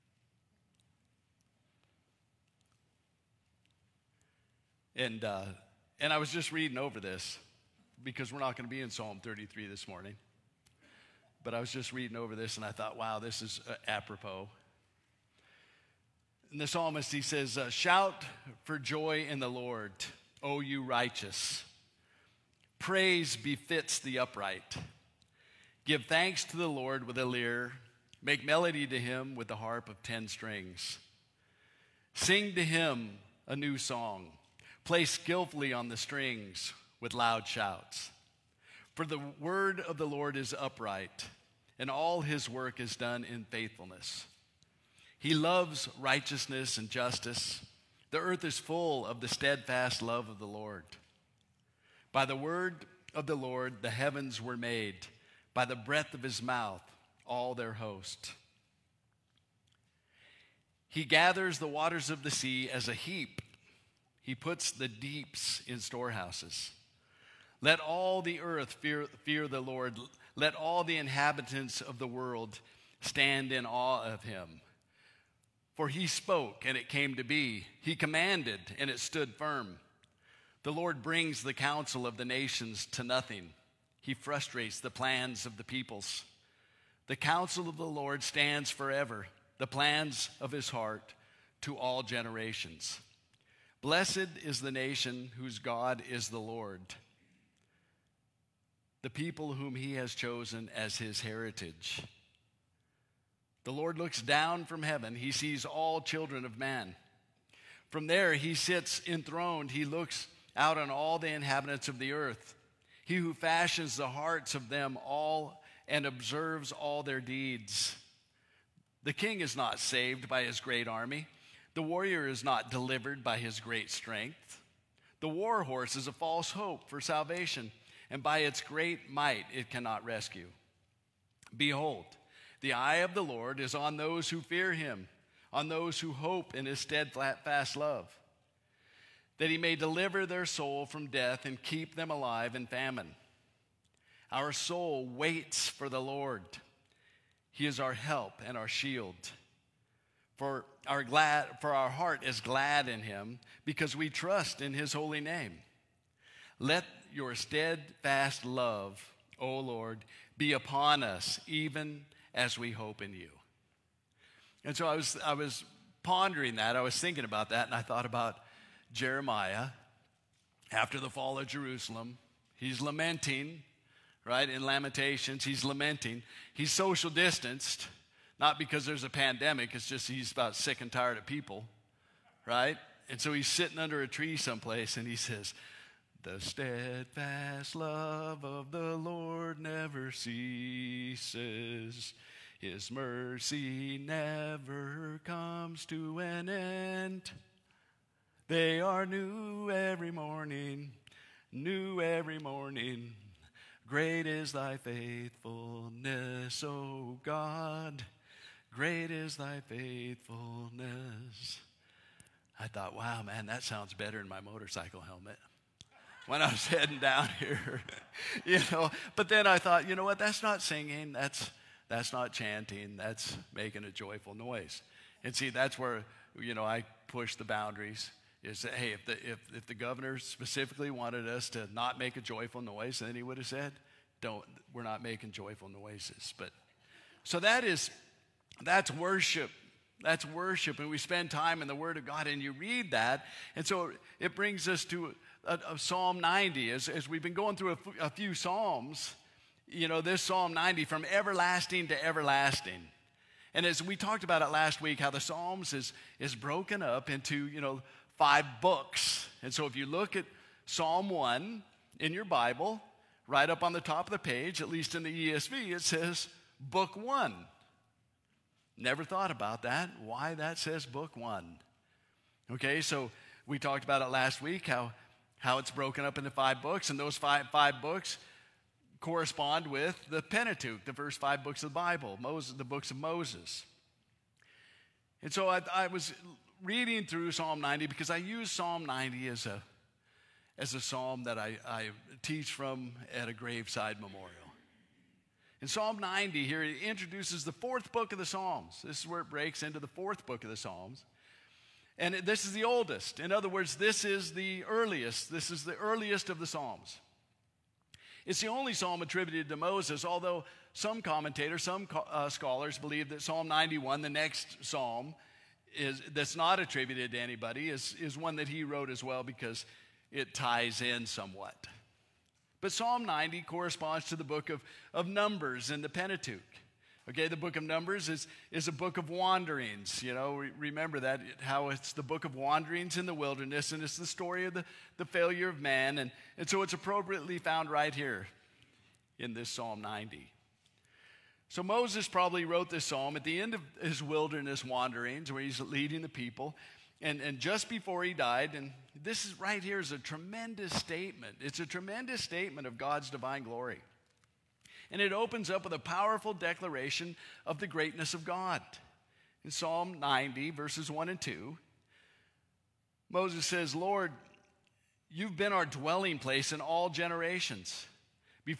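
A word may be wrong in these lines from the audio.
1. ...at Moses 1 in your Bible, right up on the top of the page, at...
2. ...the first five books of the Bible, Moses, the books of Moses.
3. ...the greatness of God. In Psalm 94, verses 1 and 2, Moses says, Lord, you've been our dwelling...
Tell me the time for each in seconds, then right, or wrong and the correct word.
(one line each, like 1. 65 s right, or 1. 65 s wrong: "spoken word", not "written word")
1. 260 s wrong: "Psalm", not "Moses"
2. 280 s right
3. 357 s wrong: "90", not "94".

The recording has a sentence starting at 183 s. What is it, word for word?
And so he's sitting under a tree someplace and he says, the steadfast love of the Lord never ceases.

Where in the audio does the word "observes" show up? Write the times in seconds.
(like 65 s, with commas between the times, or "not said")
116 s.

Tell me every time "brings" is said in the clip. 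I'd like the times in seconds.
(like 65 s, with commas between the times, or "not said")
81 s, 244 s.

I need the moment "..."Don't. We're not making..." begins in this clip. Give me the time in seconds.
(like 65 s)
234 s.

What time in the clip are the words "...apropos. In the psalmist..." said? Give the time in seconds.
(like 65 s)
13 s.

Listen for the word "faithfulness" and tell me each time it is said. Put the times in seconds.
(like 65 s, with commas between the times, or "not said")
43 s, 204 s, 209 s.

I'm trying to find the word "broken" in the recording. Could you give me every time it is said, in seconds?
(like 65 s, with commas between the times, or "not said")
256 s, 275 s.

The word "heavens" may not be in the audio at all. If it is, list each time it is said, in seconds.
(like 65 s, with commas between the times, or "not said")
53 s, 104 s.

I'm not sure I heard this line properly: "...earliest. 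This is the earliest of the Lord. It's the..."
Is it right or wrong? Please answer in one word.
wrong.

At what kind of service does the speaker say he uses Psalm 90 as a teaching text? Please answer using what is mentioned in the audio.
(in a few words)
Graveside memorial.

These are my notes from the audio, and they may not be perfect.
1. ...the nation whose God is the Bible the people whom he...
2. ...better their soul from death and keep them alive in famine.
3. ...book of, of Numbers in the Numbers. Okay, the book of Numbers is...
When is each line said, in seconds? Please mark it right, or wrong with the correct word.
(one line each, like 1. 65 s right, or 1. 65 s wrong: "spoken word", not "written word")
1. 94 s wrong: "Lord", not "Bible"
2. 139 s wrong: "deliver", not "better"
3. 324 s wrong: "Pentateuch", not "Numbers".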